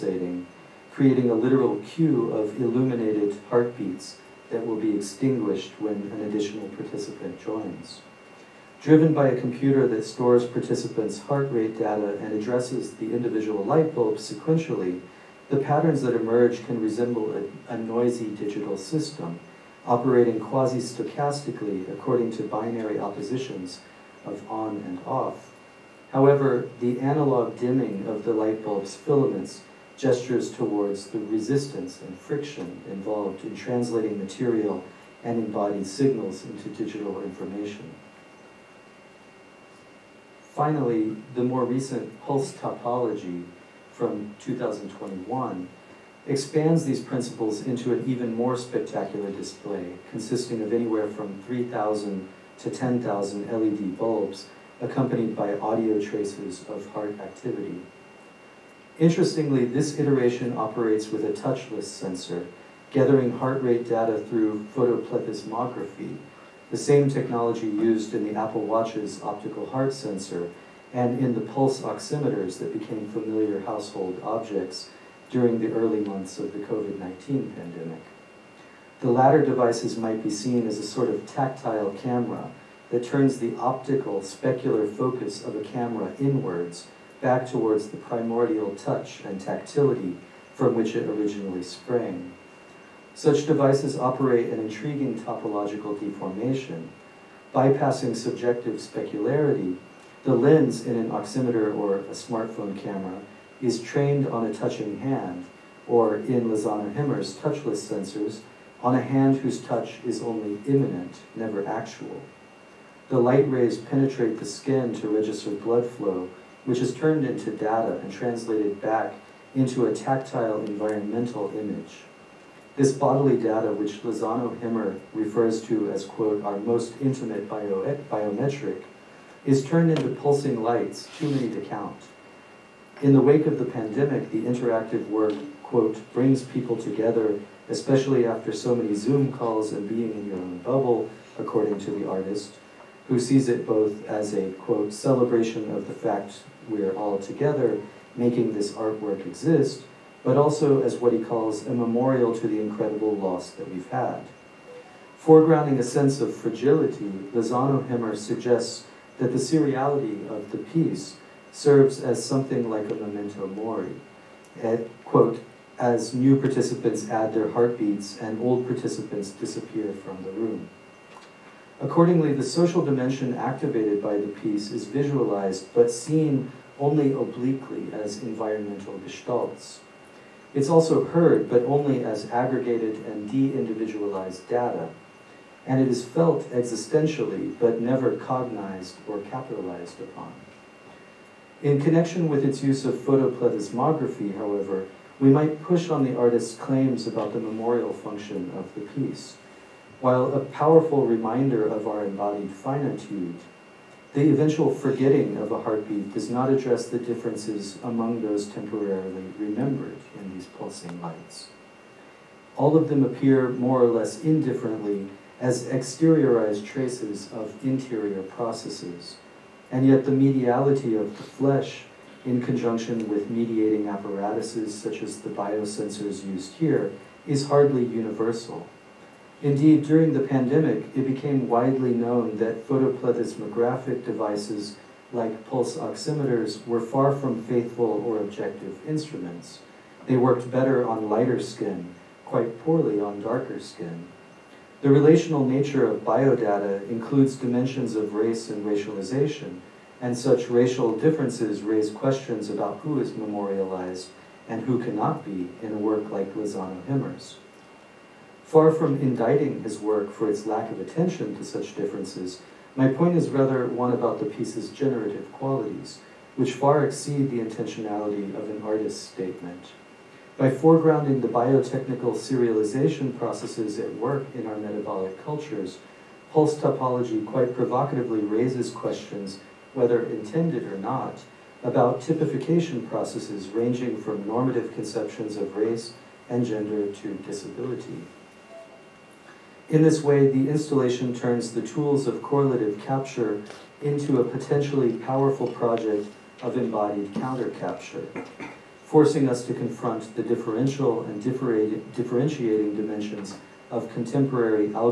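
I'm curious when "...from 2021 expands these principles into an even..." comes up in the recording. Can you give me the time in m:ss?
0:43.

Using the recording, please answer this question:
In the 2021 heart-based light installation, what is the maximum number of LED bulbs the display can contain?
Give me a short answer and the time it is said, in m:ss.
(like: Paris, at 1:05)
10,000, at 0:52.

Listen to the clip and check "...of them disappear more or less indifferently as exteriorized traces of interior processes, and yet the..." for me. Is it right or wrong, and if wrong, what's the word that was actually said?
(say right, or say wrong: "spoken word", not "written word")
wrong: "appear", not "disappear".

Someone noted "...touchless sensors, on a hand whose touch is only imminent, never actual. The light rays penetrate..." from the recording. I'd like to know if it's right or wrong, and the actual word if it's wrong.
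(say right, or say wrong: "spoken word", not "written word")
right.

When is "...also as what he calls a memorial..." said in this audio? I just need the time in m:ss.
2:30.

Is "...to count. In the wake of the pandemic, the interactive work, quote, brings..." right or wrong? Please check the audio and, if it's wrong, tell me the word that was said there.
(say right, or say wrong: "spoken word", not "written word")
right.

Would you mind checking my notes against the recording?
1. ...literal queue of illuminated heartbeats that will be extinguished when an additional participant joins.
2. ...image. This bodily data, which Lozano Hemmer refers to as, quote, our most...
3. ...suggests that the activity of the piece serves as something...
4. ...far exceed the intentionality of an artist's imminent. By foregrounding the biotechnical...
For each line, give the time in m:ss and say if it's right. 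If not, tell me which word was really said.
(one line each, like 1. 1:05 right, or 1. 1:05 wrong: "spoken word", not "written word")
1. 0:01 right
2. 2:01 right
3. 2:38 wrong: "seriality", not "activity"
4. 4:26 wrong: "statement", not "imminent".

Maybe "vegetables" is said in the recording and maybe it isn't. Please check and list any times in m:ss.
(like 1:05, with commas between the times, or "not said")
not said.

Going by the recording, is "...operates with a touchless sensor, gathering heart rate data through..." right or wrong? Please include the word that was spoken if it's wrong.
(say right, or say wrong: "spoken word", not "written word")
right.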